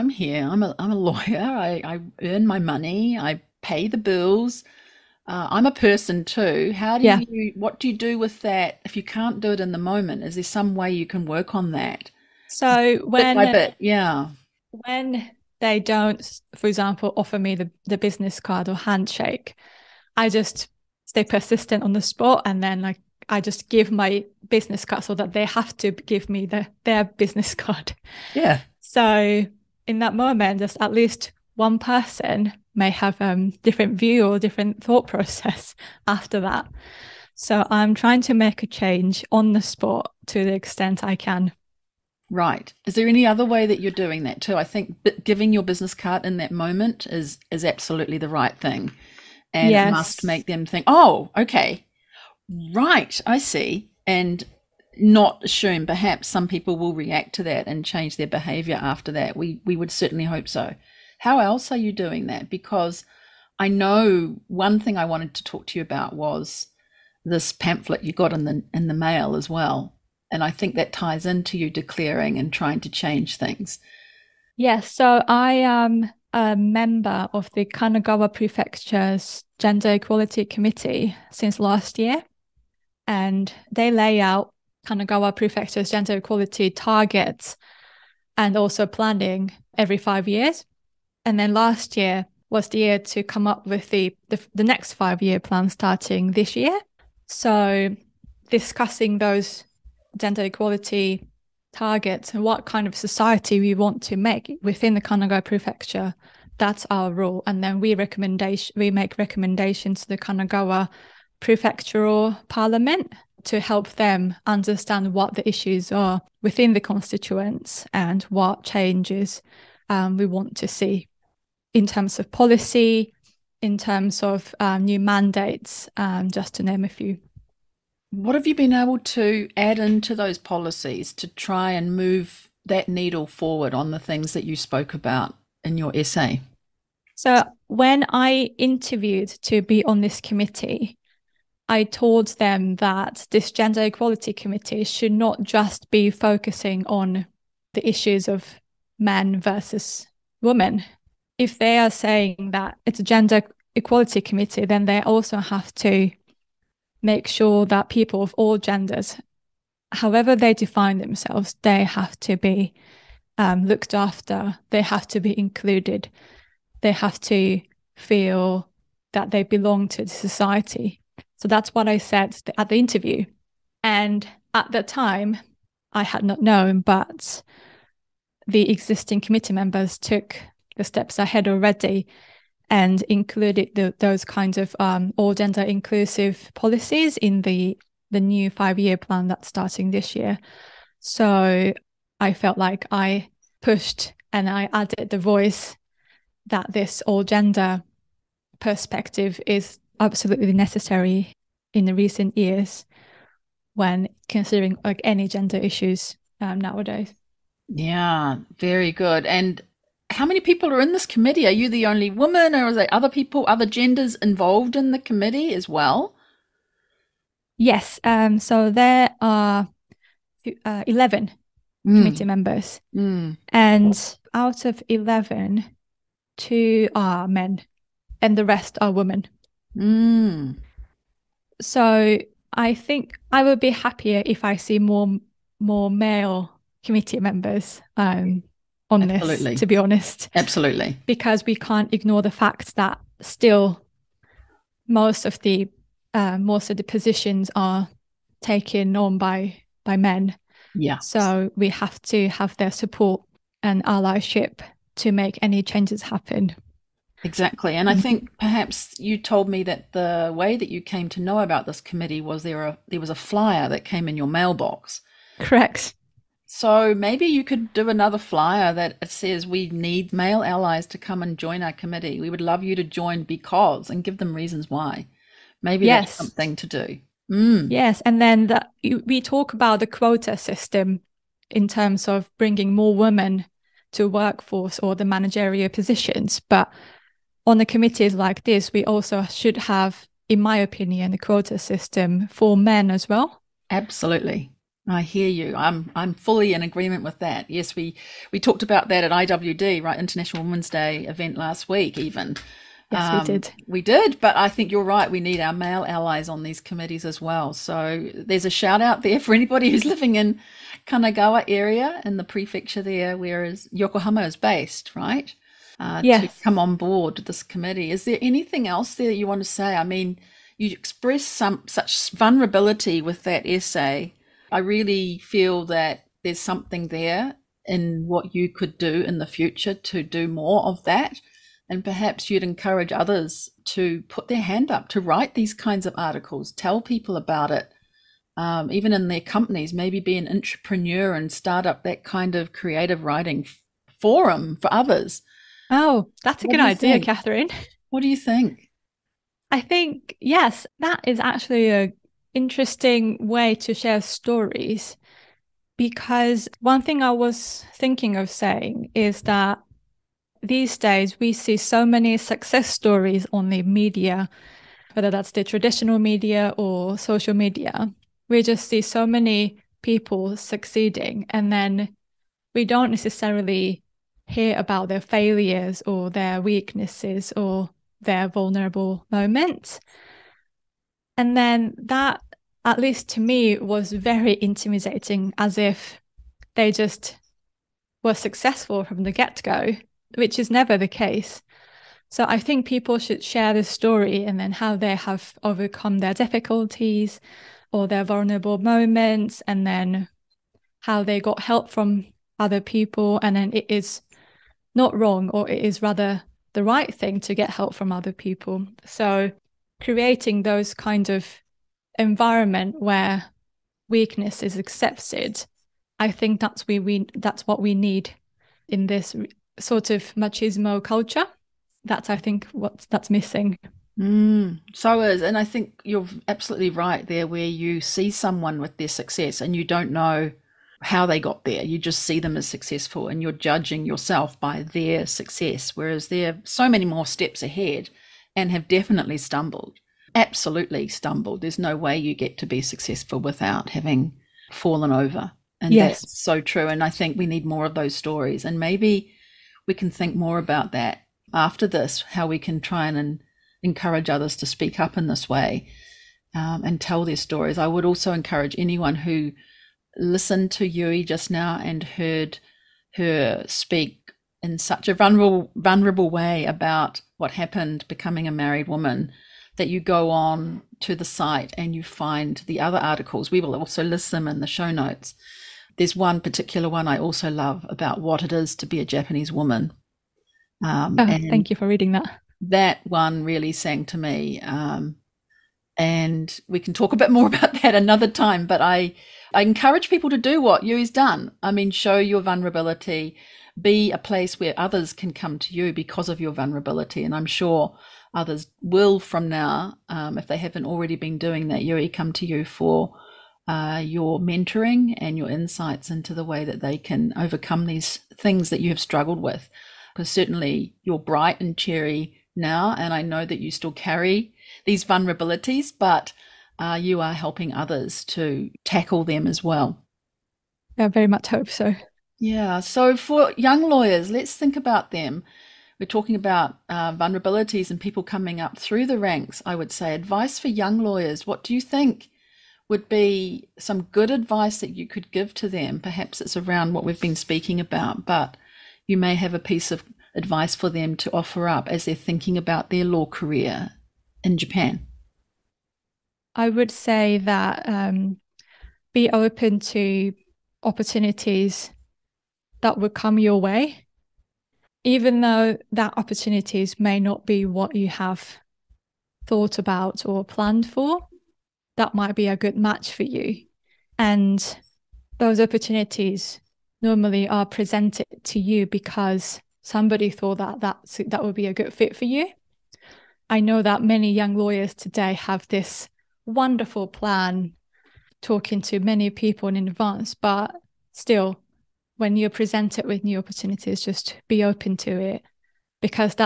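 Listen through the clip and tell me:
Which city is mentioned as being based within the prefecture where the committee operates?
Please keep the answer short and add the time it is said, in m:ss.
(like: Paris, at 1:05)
Yokohama, at 5:13.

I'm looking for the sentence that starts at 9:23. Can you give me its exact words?
And those opportunities normally are presented to you because somebody thought that that that would be a good fit for you.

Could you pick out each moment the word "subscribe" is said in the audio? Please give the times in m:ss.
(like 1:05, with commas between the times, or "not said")
not said.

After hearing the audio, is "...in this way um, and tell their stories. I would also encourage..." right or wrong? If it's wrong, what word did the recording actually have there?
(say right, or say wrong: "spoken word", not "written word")
right.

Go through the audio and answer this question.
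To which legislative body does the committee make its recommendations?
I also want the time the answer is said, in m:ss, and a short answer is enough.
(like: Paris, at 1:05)
Kanagawa prefectural parliament, at 1:50.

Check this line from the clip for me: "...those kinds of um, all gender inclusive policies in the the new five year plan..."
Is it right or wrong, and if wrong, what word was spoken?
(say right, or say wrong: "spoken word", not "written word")
right.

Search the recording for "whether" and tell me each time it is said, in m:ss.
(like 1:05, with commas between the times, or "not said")
6:04.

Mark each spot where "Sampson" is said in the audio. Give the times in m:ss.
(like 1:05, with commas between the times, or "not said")
not said.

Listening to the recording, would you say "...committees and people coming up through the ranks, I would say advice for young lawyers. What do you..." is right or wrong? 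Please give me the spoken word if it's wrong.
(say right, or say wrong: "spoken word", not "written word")
wrong: "vulnerabilities", not "committees".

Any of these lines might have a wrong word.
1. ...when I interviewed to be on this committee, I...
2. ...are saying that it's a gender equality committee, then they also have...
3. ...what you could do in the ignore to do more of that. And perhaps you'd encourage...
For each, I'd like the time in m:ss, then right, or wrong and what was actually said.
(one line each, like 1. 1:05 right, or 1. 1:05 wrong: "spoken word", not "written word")
1. 2:17 right
2. 2:31 right
3. 5:28 wrong: "future", not "ignore".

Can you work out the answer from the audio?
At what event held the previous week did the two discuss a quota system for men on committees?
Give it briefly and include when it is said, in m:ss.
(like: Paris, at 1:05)
International Women's Day, at 4:59.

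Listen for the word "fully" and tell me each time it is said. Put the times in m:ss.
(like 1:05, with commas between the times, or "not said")
4:56.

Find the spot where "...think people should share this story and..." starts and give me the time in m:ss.
6:32.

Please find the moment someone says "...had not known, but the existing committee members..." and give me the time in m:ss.
2:56.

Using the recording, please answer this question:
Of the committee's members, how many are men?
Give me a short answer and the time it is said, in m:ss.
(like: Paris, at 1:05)
2, at 3:46.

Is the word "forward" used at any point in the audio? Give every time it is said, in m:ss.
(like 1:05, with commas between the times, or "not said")
2:13.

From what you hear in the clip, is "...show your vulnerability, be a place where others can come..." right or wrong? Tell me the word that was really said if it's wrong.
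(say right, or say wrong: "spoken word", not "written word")
right.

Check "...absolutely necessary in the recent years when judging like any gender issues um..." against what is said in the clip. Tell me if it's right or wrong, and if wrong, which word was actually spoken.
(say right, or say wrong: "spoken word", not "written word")
wrong: "considering", not "judging".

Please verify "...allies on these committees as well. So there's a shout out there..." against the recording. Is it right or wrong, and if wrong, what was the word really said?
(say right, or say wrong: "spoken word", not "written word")
right.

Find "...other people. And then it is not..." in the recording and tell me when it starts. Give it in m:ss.
6:42.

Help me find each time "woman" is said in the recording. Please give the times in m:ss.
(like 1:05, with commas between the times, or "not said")
3:32, 7:48, 7:59.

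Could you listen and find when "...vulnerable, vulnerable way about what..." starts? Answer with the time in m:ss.
7:44.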